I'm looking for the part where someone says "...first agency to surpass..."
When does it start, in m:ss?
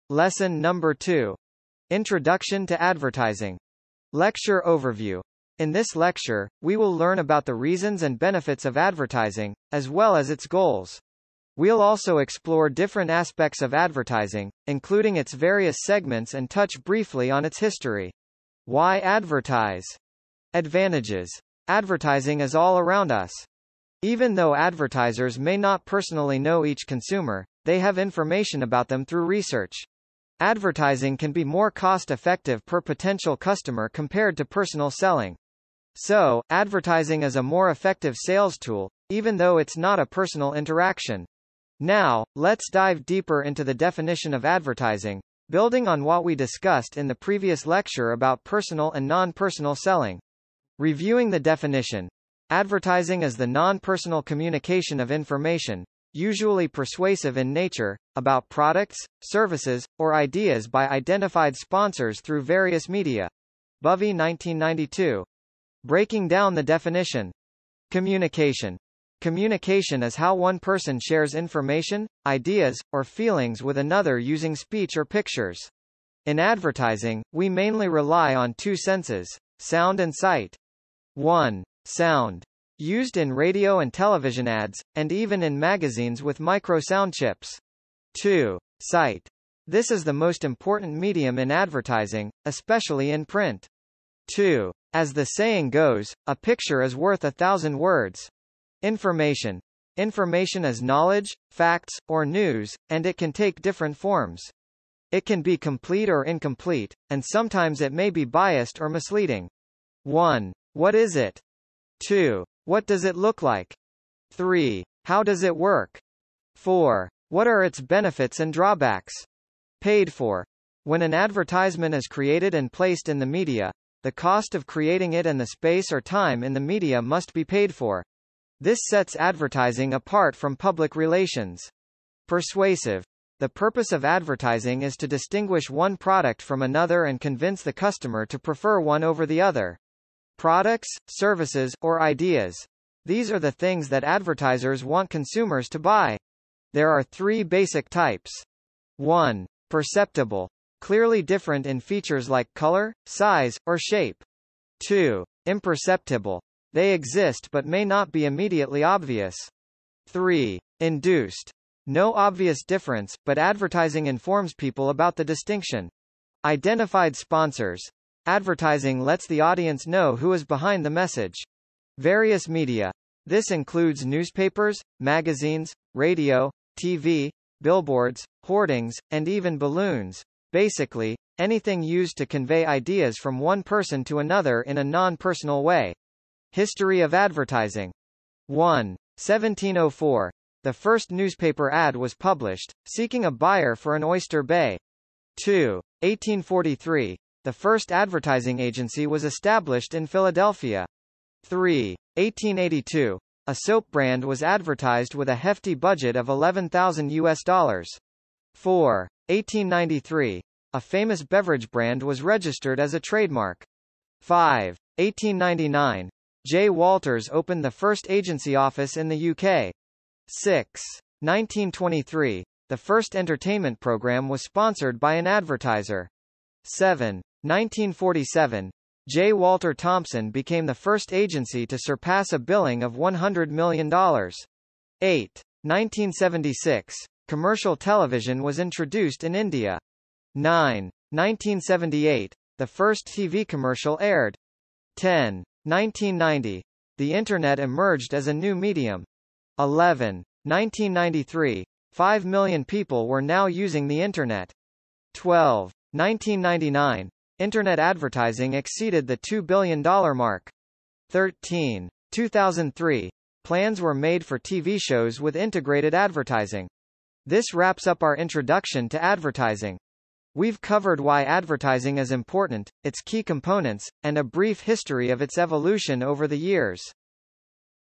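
3:50.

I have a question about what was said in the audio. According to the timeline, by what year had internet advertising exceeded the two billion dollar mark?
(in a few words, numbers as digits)
1999.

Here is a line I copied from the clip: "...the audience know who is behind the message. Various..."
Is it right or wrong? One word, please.
right.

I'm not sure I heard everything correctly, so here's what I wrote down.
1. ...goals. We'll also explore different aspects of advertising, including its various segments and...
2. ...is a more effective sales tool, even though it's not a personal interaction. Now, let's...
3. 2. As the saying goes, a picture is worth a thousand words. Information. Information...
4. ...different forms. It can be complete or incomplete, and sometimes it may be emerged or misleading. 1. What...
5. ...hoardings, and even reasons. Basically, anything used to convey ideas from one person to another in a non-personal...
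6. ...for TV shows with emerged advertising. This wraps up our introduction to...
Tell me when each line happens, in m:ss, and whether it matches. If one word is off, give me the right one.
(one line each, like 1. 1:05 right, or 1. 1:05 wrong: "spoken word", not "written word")
1. 0:10 right
2. 0:37 right
3. 1:34 right
4. 1:43 wrong: "biased", not "emerged"
5. 2:58 wrong: "balloons", not "reasons"
6. 4:24 wrong: "integrated", not "emerged".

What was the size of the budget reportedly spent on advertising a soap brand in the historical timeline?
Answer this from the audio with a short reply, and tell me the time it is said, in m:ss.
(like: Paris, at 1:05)
$11,000, at 3:26.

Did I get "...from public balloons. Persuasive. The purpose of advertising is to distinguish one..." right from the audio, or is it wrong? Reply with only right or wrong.
wrong.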